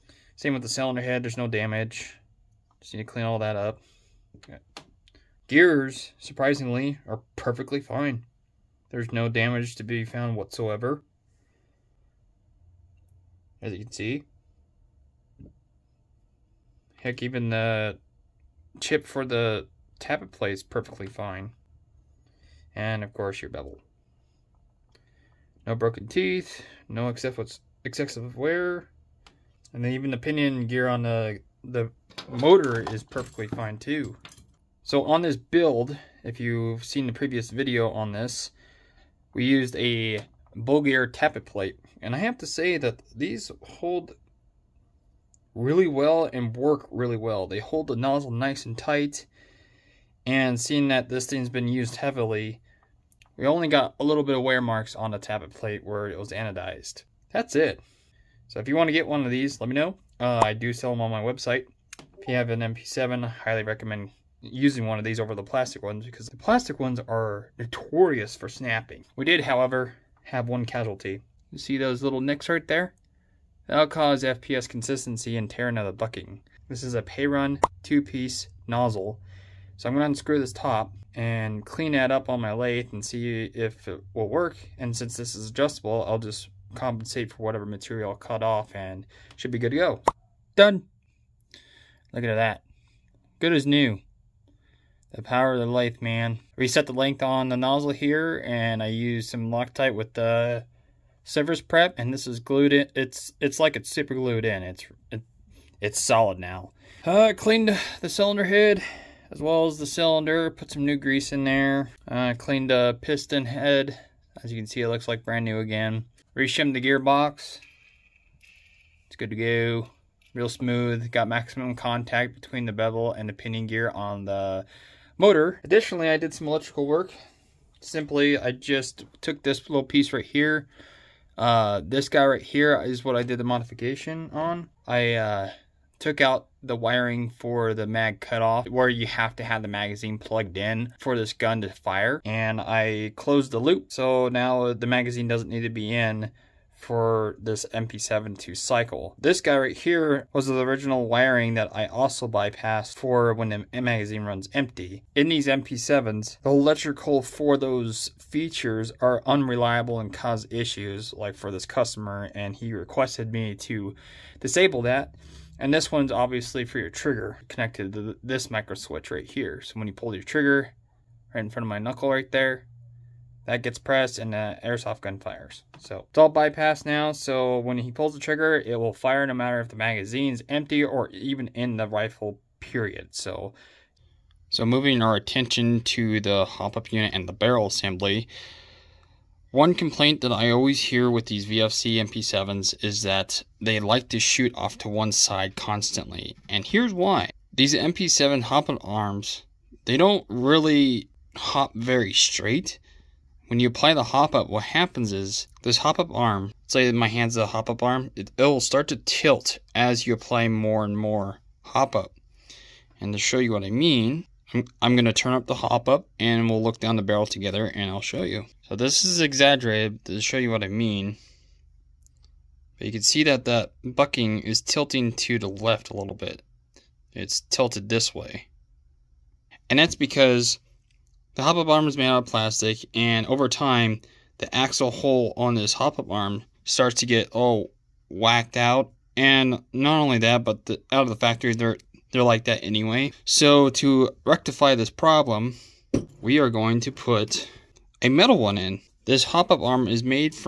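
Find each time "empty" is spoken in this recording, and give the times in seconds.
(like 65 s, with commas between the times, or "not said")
154 s, 180 s.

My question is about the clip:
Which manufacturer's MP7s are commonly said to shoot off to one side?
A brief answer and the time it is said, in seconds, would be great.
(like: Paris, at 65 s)
VFC, at 191 s.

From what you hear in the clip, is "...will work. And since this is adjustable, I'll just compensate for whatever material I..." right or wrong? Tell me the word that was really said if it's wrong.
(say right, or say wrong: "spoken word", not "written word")
right.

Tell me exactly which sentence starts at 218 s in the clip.
So this is exaggerated to show you what I mean.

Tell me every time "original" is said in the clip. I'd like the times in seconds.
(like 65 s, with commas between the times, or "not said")
150 s.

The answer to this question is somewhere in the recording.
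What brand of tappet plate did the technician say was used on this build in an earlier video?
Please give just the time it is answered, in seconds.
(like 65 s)
40 s.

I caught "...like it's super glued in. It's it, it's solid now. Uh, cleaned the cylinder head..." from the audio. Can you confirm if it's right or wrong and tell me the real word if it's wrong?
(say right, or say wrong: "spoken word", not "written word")
right.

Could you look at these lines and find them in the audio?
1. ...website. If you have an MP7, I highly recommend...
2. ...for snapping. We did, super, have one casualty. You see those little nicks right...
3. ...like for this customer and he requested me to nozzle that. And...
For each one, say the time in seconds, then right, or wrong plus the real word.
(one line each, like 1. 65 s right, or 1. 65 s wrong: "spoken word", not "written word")
1. 61 s right
2. 68 s wrong: "however", not "super"
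3. 161 s wrong: "disable", not "nozzle".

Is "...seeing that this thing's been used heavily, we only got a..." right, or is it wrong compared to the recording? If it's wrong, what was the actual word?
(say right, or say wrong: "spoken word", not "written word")
right.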